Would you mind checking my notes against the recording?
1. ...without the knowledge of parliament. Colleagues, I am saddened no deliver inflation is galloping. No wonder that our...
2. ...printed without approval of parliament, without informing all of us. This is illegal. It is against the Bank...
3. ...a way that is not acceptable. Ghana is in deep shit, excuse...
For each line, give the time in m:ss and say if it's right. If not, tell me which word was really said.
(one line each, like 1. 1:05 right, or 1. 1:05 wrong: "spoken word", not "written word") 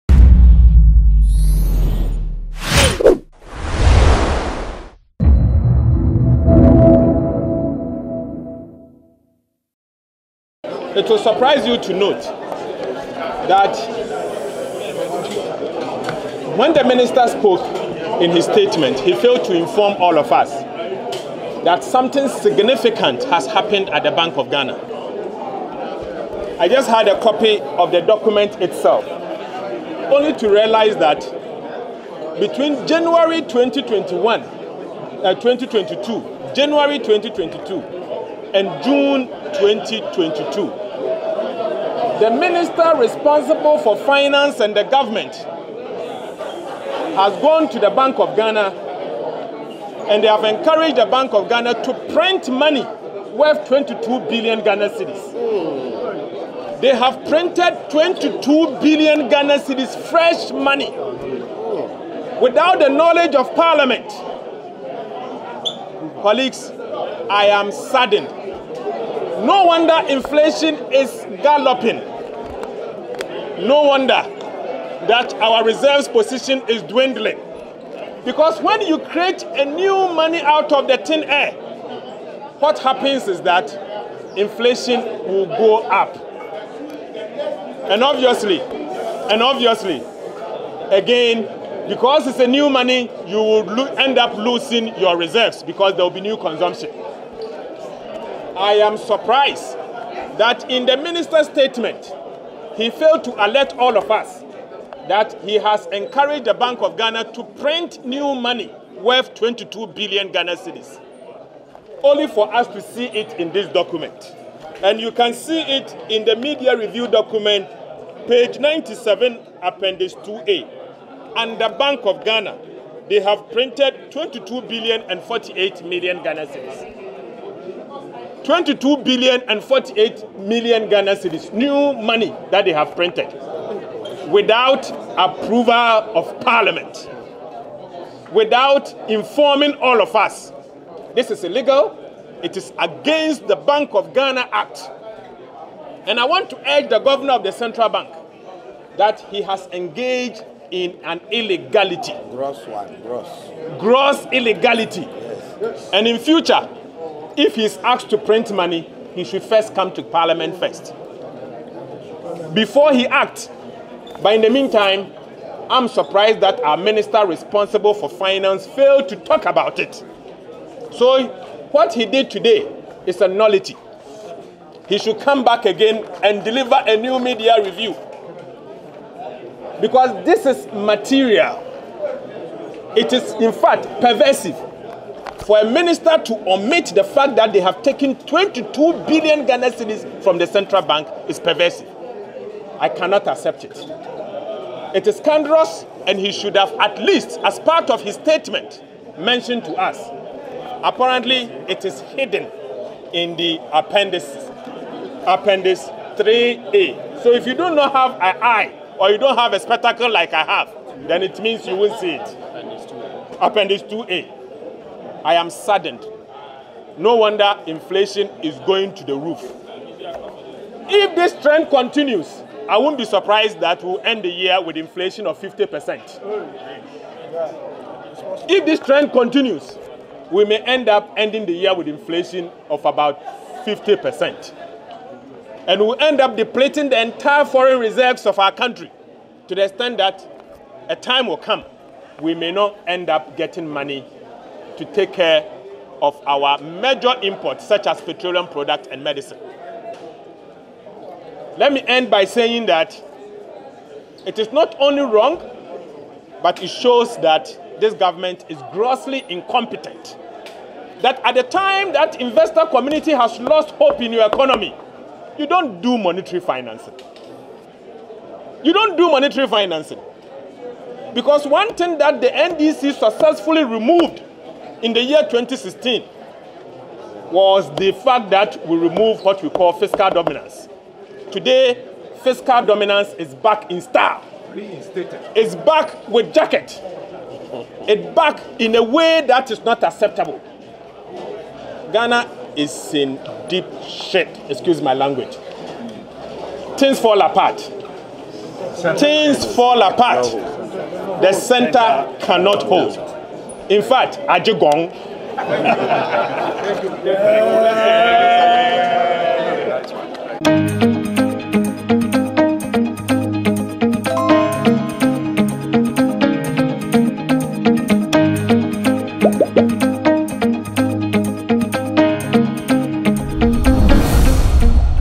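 1. 1:02 wrong: "wonder", not "deliver"
2. 2:12 right
3. 4:48 right.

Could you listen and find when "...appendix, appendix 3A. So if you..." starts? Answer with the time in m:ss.
3:23.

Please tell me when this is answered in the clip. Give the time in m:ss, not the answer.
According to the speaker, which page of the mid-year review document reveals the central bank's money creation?
1:58.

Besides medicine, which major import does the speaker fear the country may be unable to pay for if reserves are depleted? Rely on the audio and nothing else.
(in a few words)
petroleum products.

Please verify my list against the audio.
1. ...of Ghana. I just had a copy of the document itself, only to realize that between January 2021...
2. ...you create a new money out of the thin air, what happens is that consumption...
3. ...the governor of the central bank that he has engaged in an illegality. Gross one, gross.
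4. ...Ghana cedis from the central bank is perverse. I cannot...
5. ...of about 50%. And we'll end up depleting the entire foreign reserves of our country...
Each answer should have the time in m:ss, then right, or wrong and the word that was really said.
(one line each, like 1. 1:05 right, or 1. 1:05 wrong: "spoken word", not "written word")
1. 0:24 right
2. 1:18 wrong: "inflation", not "consumption"
3. 2:26 right
4. 3:09 right
5. 3:52 right.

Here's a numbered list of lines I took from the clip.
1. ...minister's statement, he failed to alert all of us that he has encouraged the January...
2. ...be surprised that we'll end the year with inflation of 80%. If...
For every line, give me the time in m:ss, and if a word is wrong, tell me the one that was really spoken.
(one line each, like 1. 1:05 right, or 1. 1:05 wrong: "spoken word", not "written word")
1. 1:40 wrong: "Bank", not "January"
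2. 3:42 wrong: "50", not "80".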